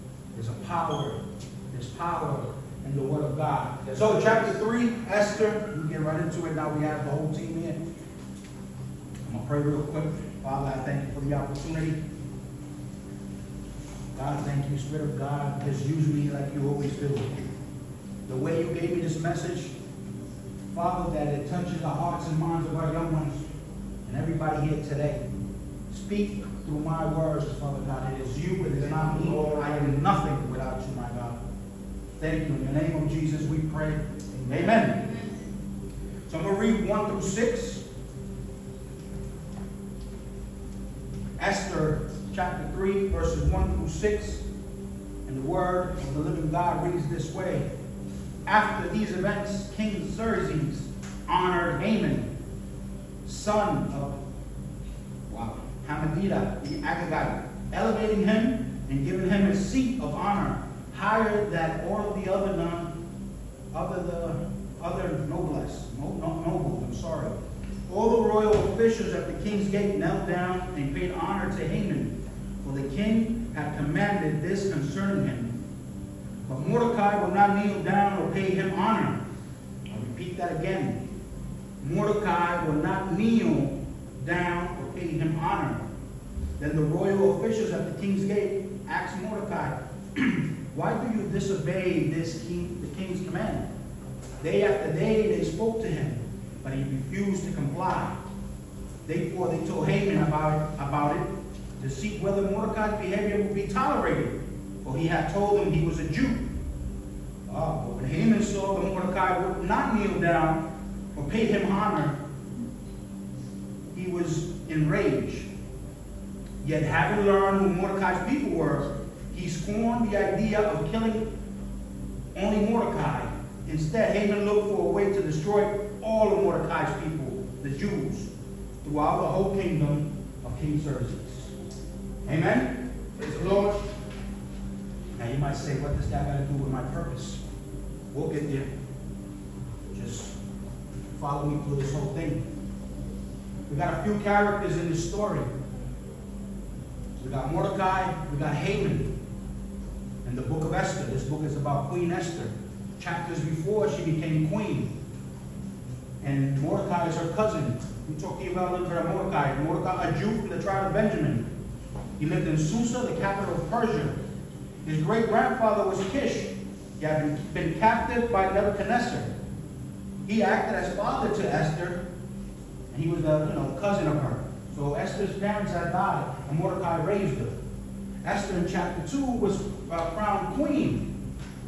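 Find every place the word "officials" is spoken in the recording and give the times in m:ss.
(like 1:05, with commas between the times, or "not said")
1:08, 1:27.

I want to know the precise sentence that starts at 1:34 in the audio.
Day after day they spoke to him, but he refused to comply.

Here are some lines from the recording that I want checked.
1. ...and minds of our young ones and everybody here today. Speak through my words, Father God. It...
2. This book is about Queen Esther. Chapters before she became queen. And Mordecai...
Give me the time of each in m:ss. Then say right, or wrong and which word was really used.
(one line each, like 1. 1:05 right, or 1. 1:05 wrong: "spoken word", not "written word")
1. 0:22 right
2. 2:31 right.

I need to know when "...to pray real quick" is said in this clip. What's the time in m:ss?
0:09.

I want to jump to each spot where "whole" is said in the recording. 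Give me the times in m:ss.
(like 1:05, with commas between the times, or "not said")
0:07, 2:09, 2:21.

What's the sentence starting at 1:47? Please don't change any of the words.
Uh, but when Haman saw that Mordecai would not kneel down or pay him honor, he was enraged.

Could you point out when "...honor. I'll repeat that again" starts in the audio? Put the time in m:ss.
1:18.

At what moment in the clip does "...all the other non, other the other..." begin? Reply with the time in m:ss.
1:01.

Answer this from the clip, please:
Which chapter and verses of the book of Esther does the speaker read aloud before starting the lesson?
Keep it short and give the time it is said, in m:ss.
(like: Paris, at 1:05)
Chapter 3, verses 1-6, at 0:41.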